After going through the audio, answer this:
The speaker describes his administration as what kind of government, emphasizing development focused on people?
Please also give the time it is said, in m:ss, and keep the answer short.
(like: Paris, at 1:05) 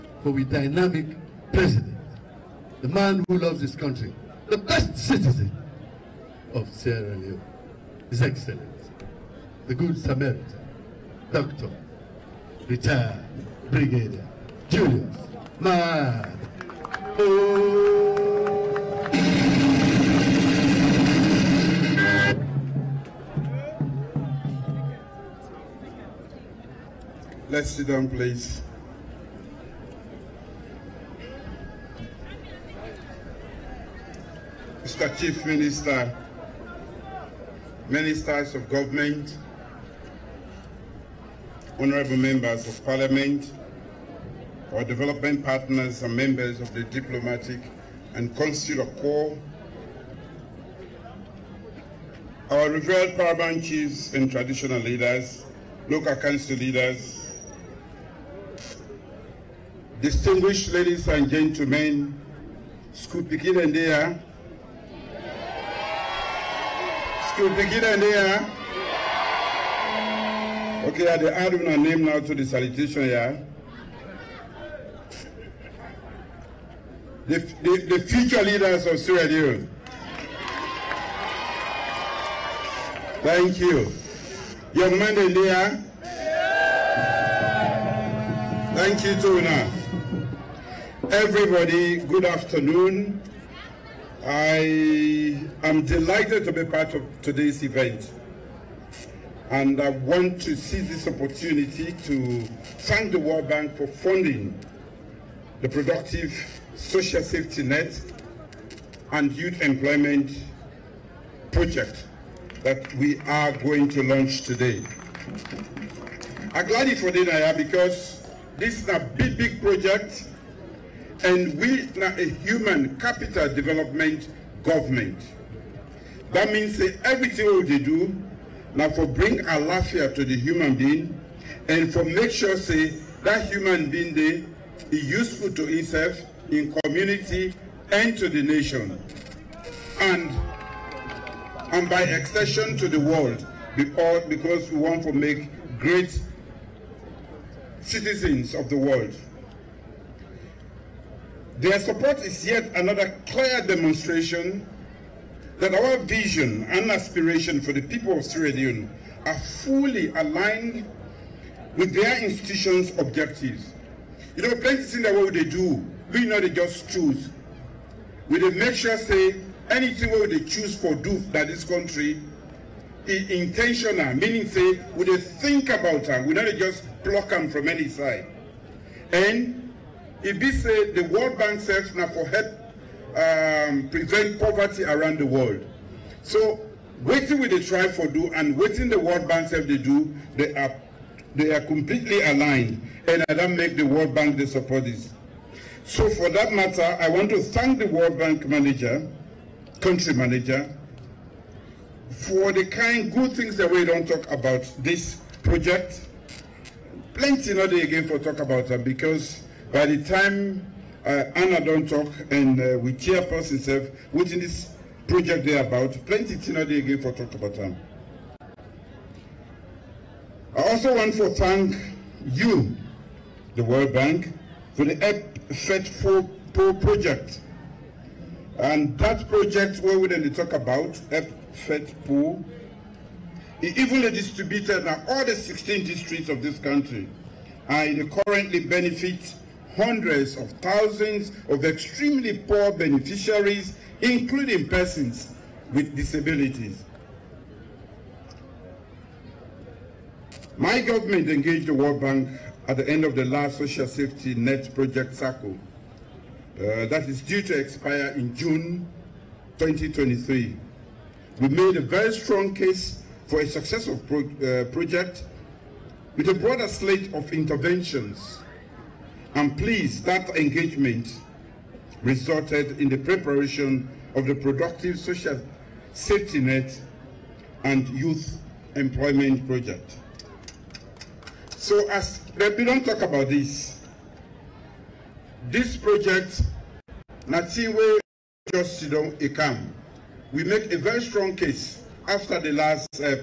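human capital development government, at 2:02.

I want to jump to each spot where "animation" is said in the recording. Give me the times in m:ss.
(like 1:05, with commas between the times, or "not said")
not said.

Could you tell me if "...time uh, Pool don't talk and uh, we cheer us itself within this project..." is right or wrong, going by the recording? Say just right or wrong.
wrong.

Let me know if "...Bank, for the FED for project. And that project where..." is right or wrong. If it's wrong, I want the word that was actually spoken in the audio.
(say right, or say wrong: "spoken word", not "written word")
right.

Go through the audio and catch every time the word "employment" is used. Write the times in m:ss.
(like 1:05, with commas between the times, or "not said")
1:49, 4:38.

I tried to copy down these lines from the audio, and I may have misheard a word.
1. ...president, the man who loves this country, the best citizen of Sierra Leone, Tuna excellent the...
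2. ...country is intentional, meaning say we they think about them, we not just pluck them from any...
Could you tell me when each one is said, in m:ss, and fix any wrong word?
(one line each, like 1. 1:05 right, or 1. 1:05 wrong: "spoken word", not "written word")
1. 0:01 wrong: "His", not "Tuna"
2. 2:51 right.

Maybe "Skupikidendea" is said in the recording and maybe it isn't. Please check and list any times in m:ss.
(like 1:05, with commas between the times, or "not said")
1:02, 1:07.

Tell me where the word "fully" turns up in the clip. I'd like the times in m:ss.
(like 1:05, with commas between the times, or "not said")
2:39.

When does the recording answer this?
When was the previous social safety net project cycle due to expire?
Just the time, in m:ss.
4:18.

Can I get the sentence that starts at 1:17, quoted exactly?
The, the, the future leaders of Sierra Leone.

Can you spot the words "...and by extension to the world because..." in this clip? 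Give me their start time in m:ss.
2:21.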